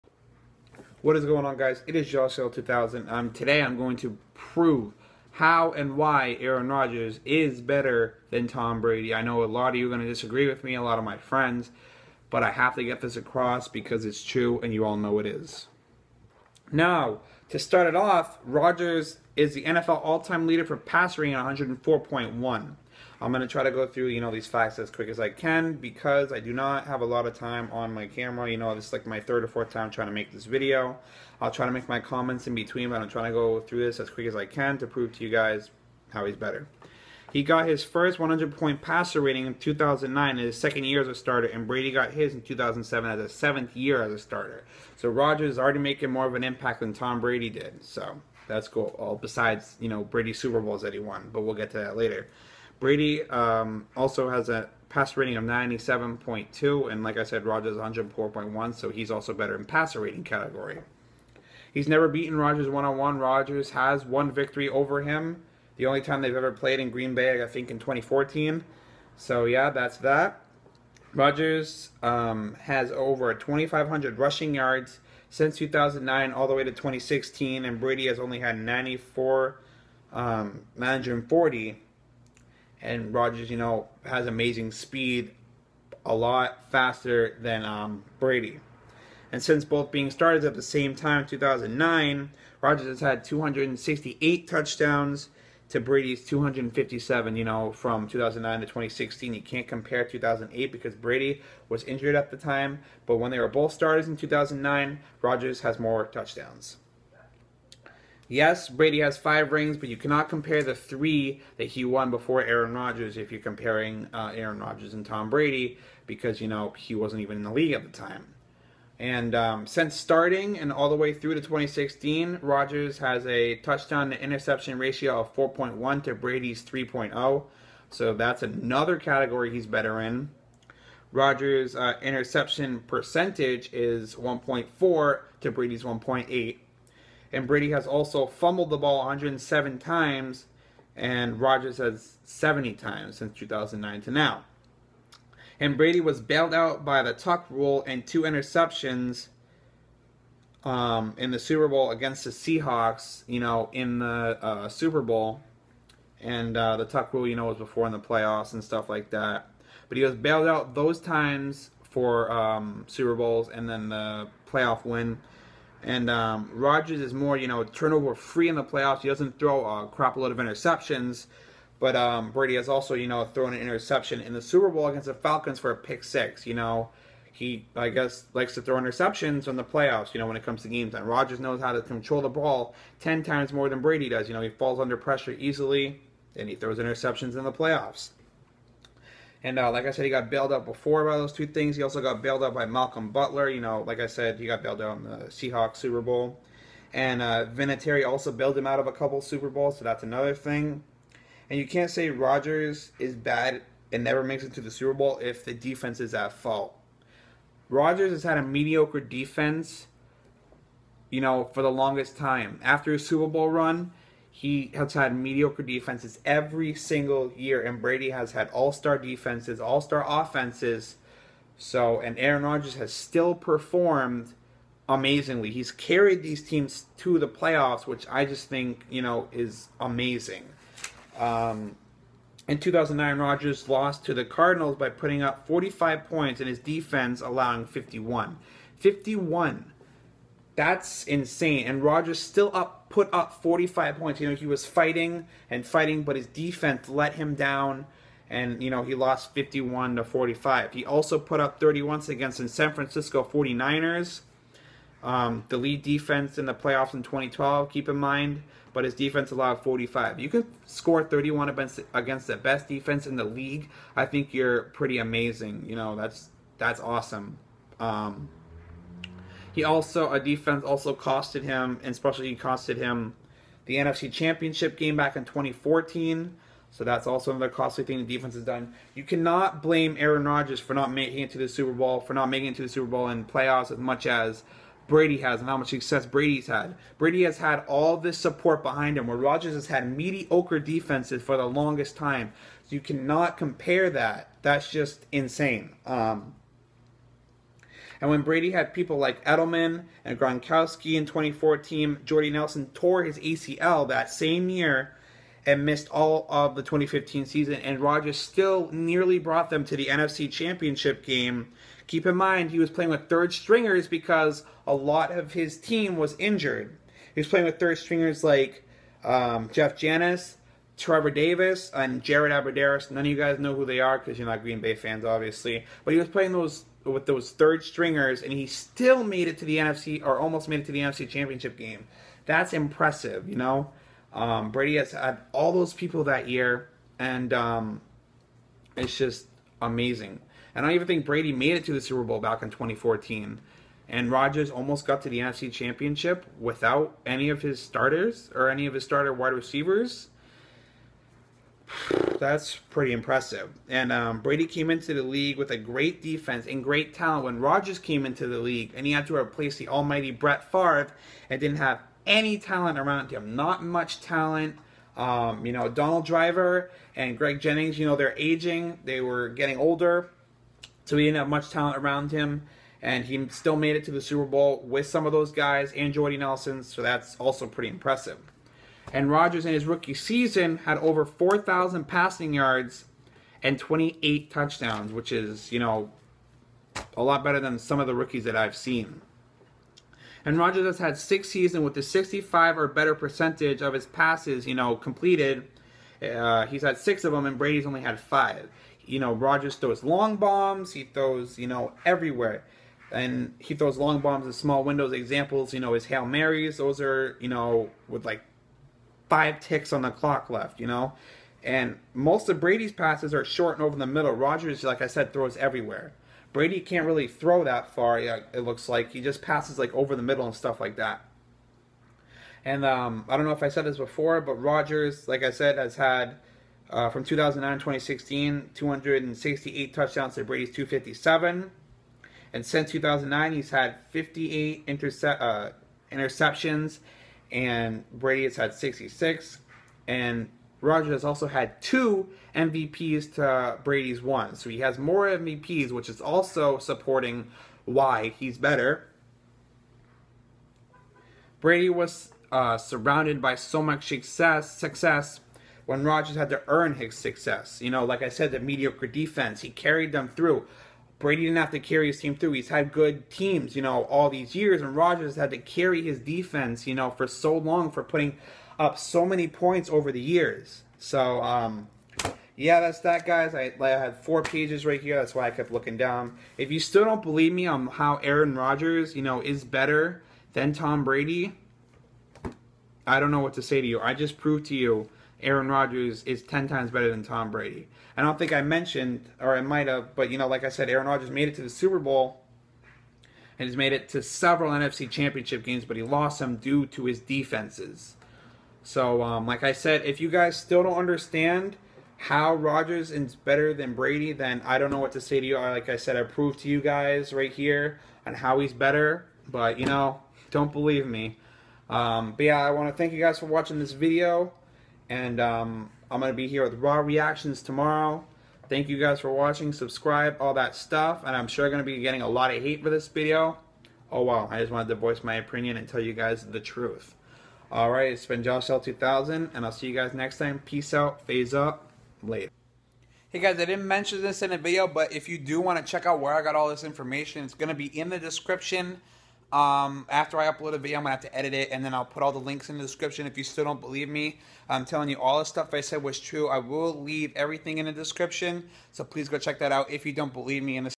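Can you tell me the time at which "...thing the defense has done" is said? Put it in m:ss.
4:37.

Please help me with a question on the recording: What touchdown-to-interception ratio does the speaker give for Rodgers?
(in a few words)
4.1.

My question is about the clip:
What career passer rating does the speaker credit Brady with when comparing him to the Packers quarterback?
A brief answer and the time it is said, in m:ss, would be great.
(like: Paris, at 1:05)
97.2, at 0:55.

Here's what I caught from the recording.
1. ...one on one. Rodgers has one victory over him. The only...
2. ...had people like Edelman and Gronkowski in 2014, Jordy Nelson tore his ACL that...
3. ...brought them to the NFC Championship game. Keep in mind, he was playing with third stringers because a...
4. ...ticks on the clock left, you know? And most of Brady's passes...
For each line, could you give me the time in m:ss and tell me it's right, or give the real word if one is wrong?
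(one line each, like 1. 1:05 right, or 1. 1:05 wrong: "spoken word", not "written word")
1. 1:02 right
2. 4:58 right
3. 5:09 right
4. 6:49 right.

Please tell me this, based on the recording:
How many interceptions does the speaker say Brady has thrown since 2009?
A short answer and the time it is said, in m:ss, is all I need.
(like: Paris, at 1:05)
66, at 7:18.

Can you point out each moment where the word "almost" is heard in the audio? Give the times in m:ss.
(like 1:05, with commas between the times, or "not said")
5:30, 5:44.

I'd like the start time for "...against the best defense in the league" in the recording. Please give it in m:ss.
4:21.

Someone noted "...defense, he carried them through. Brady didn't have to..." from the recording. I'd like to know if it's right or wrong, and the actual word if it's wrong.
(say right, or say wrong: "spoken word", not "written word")
right.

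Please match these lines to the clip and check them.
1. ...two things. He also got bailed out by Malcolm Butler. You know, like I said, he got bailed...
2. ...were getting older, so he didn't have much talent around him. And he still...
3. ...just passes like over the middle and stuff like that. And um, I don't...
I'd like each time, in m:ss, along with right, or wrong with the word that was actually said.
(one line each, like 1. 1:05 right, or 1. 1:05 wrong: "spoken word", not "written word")
1. 3:11 right
2. 6:08 right
3. 6:59 right.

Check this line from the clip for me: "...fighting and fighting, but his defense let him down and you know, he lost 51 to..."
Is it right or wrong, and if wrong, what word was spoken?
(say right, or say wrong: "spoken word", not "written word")
right.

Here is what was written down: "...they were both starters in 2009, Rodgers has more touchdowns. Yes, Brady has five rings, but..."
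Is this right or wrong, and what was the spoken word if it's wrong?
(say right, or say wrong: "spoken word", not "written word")
right.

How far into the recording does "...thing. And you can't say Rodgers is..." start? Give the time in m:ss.
3:20.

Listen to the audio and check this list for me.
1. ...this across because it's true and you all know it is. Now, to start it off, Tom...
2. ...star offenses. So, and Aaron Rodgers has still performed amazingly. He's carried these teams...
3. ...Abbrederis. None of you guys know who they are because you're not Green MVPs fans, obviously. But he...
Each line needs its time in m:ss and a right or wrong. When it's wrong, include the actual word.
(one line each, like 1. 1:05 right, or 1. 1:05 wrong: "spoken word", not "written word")
1. 0:13 wrong: "Rodgers", not "Tom"
2. 3:39 right
3. 5:22 wrong: "Bay", not "MVPs".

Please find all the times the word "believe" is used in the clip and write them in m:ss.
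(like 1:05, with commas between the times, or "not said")
7:57, 8:30, 9:03, 9:10.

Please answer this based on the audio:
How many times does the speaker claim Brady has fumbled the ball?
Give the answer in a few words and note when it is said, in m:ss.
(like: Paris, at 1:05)
107, at 2:18.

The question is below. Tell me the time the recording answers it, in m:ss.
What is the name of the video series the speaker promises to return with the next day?
8:36.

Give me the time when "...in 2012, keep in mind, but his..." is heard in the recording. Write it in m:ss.
4:16.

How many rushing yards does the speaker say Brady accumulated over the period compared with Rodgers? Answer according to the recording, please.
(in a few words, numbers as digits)
940.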